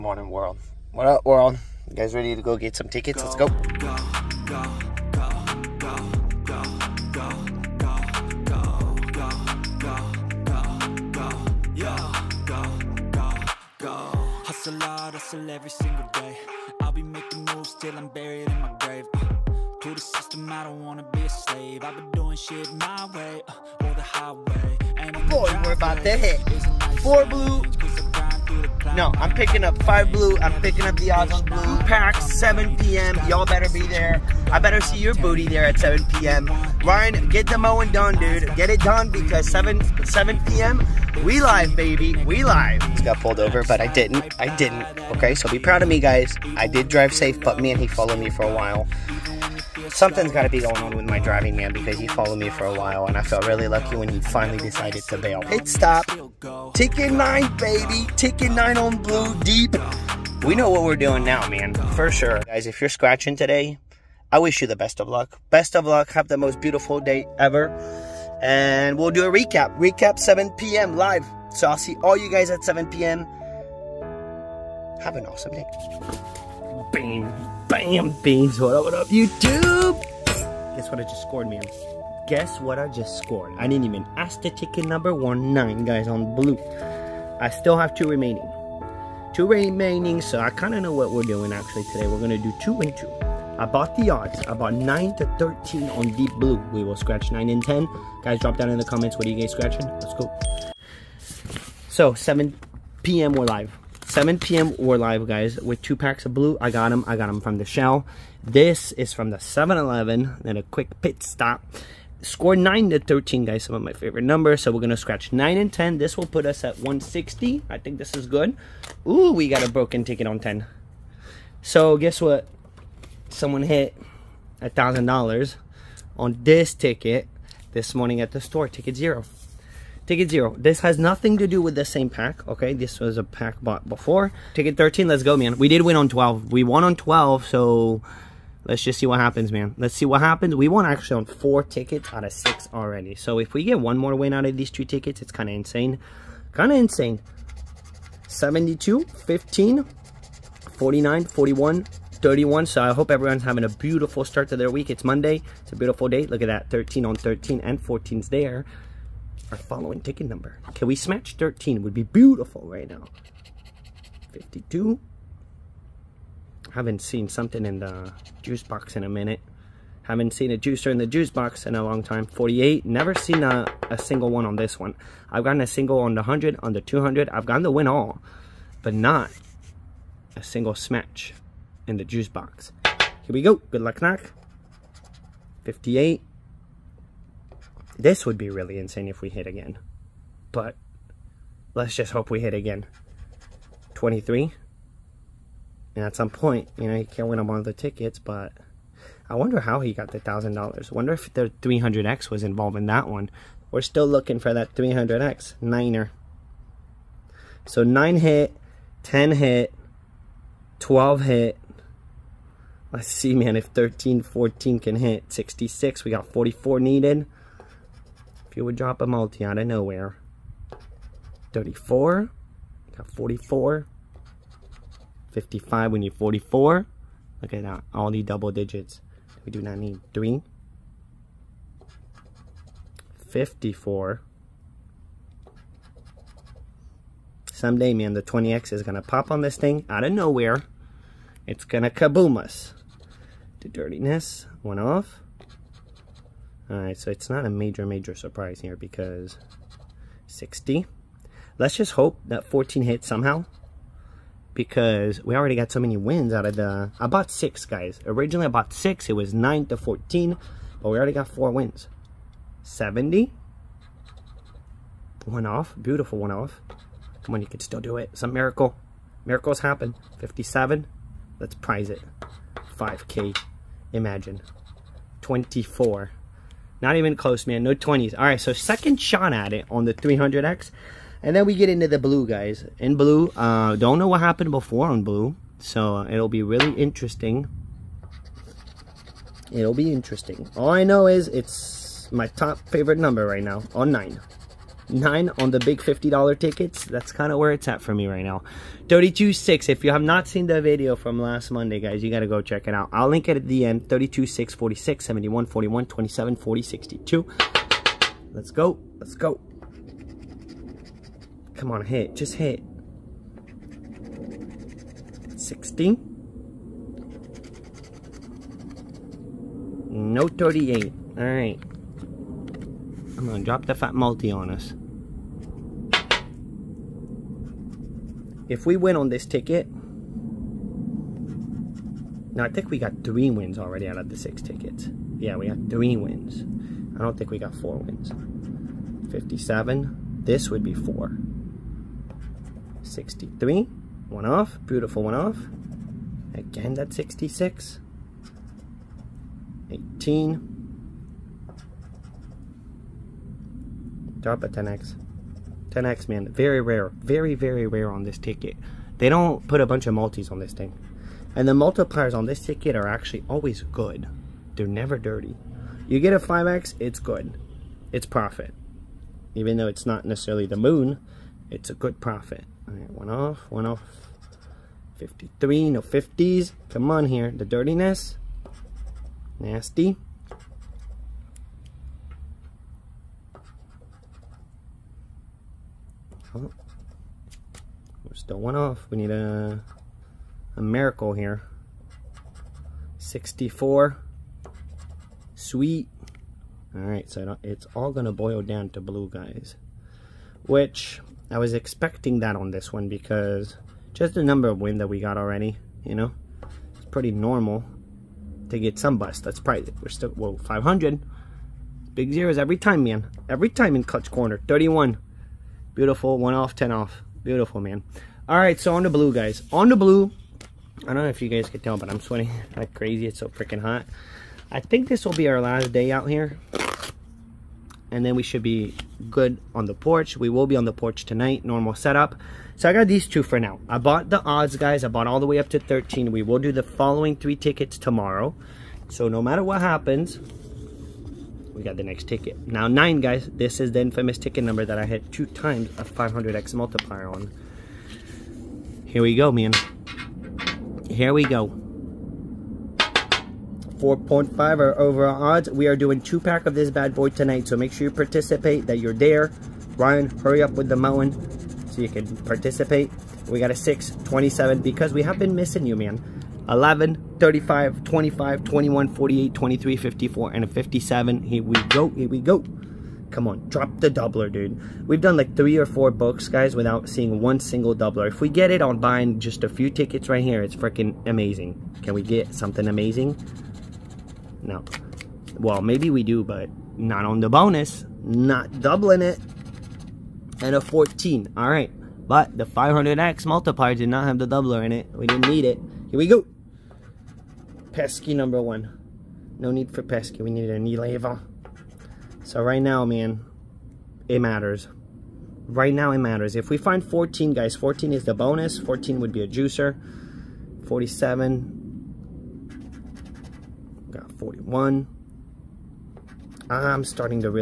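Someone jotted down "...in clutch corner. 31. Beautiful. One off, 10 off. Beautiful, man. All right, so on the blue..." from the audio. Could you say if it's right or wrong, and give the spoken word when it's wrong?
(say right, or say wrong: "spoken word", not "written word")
right.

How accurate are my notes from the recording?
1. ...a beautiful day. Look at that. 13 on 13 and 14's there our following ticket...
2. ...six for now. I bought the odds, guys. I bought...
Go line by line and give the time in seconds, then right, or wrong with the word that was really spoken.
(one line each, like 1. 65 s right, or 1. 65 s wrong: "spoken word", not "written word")
1. 155 s right
2. 433 s wrong: "two", not "six".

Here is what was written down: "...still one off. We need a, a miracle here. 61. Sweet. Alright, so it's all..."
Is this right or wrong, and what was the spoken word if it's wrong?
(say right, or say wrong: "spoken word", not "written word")
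wrong: "64", not "61".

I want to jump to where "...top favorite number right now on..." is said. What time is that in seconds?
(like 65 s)
292 s.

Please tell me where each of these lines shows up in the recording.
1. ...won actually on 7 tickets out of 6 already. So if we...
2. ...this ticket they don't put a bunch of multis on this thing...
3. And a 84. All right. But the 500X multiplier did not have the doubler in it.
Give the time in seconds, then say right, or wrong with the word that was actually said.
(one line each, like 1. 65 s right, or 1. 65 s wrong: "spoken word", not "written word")
1. 140 s wrong: "4", not "7"
2. 358 s right
3. 490 s wrong: "14", not "84".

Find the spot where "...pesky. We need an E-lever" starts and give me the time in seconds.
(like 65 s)
499 s.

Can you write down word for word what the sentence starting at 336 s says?
I don't think we got four wins.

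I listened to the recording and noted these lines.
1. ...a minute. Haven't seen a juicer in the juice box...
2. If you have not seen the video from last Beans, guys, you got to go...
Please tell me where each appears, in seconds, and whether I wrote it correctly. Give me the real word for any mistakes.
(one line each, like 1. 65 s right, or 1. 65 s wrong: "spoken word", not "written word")
1. 169 s right
2. 299 s wrong: "Monday", not "Beans".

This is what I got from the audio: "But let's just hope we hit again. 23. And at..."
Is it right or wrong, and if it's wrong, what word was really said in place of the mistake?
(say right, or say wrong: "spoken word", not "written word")
right.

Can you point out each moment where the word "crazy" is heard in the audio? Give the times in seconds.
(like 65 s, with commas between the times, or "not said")
422 s.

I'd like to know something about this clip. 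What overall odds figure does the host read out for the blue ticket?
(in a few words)
4.5.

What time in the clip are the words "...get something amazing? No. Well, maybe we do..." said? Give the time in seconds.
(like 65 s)
482 s.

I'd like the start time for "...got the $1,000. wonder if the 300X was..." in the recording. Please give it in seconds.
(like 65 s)
199 s.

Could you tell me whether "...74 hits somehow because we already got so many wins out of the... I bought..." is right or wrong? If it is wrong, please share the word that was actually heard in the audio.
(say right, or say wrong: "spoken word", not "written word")
wrong: "14", not "74".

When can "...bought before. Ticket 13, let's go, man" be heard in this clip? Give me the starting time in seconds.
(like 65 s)
133 s.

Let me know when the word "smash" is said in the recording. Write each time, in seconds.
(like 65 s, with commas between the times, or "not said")
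160 s, 180 s.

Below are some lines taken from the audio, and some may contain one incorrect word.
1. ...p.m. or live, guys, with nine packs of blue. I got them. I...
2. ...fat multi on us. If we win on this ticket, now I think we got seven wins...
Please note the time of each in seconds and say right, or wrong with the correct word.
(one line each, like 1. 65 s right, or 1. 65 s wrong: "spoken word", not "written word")
1. 104 s wrong: "two", not "nine"
2. 323 s wrong: "three", not "seven".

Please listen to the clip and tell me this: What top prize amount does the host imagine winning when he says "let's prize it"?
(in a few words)
5K.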